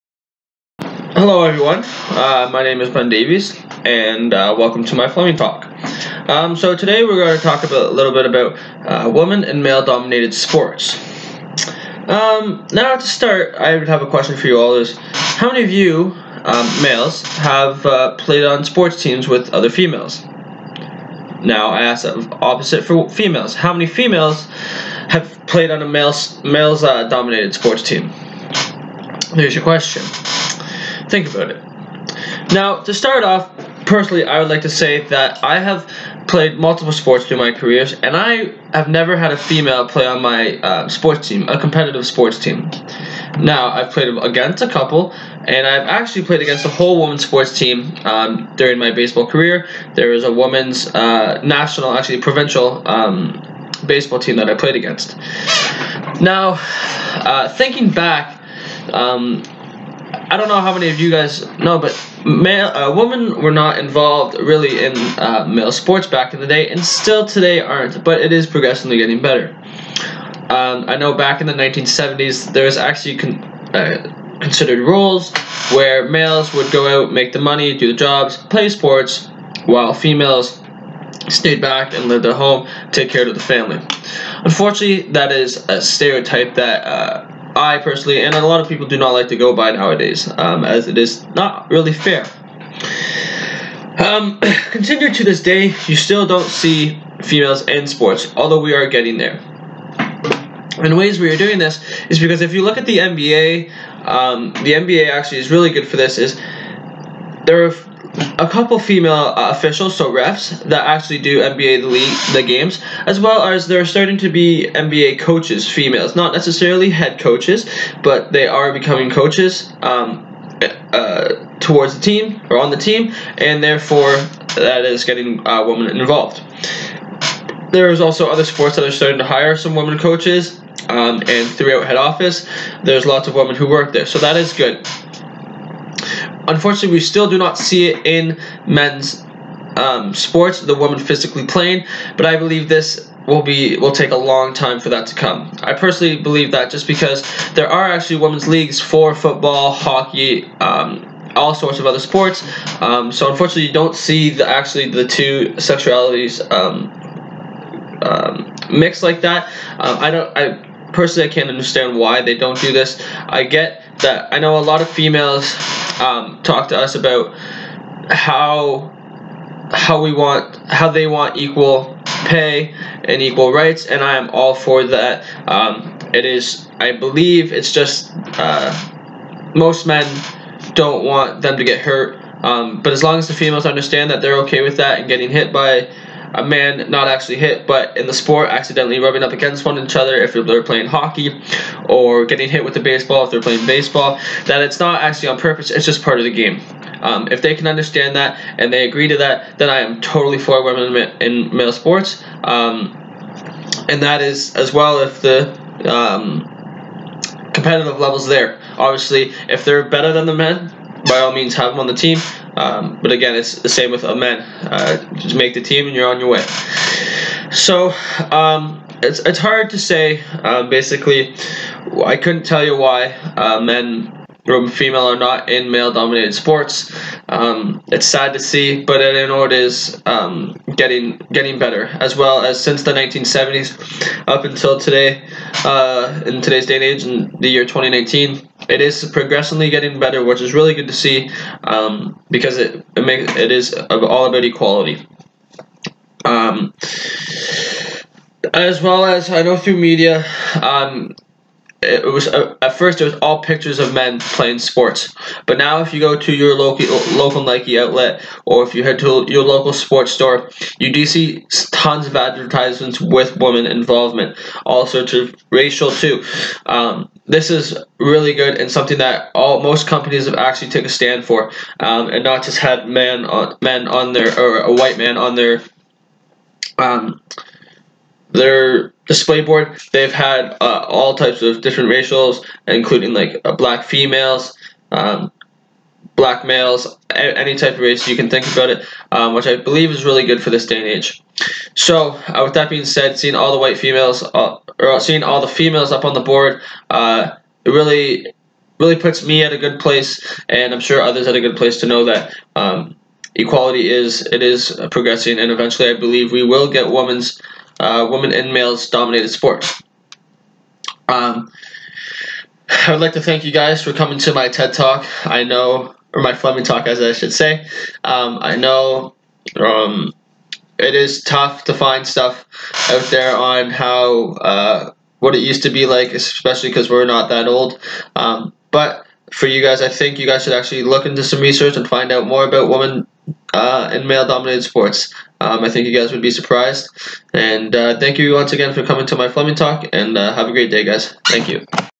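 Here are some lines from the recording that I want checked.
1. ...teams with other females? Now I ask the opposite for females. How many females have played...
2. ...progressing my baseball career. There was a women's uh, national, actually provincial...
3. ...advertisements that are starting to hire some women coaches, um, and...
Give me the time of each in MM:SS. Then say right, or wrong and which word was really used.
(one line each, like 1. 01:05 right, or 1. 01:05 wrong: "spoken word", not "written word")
1. 00:19 right
2. 00:48 wrong: "during", not "progressing"
3. 02:08 wrong: "sports", not "advertisements".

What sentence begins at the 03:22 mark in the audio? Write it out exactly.
Um, and that is as well if the um, competitive levels there.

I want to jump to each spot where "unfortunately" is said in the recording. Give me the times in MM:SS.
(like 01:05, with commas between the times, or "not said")
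01:24, 02:16, 02:33.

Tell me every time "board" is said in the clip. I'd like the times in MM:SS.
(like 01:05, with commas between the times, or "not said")
04:39, 04:56.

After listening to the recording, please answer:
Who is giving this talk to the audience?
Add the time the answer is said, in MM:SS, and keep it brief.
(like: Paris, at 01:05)
Ben Davies, at 00:02.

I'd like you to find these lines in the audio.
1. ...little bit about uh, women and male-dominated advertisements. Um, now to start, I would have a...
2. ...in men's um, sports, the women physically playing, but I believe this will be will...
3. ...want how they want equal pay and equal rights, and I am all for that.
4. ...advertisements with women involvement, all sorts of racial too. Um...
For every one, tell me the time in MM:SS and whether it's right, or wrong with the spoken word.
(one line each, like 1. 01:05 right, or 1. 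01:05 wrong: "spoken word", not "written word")
1. 00:07 wrong: "sports", not "advertisements"
2. 02:18 right
3. 02:50 right
4. 04:22 right.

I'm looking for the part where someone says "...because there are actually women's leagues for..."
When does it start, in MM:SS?
02:26.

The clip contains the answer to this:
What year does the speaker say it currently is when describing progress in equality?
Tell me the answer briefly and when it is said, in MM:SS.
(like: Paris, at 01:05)
2019, at 03:57.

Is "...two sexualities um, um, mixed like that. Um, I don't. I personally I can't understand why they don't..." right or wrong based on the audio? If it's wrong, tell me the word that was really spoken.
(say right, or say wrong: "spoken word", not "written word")
right.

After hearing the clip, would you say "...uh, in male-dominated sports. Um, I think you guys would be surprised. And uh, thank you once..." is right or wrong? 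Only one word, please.
right.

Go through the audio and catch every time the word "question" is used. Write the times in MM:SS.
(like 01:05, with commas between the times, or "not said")
00:14, 00:29.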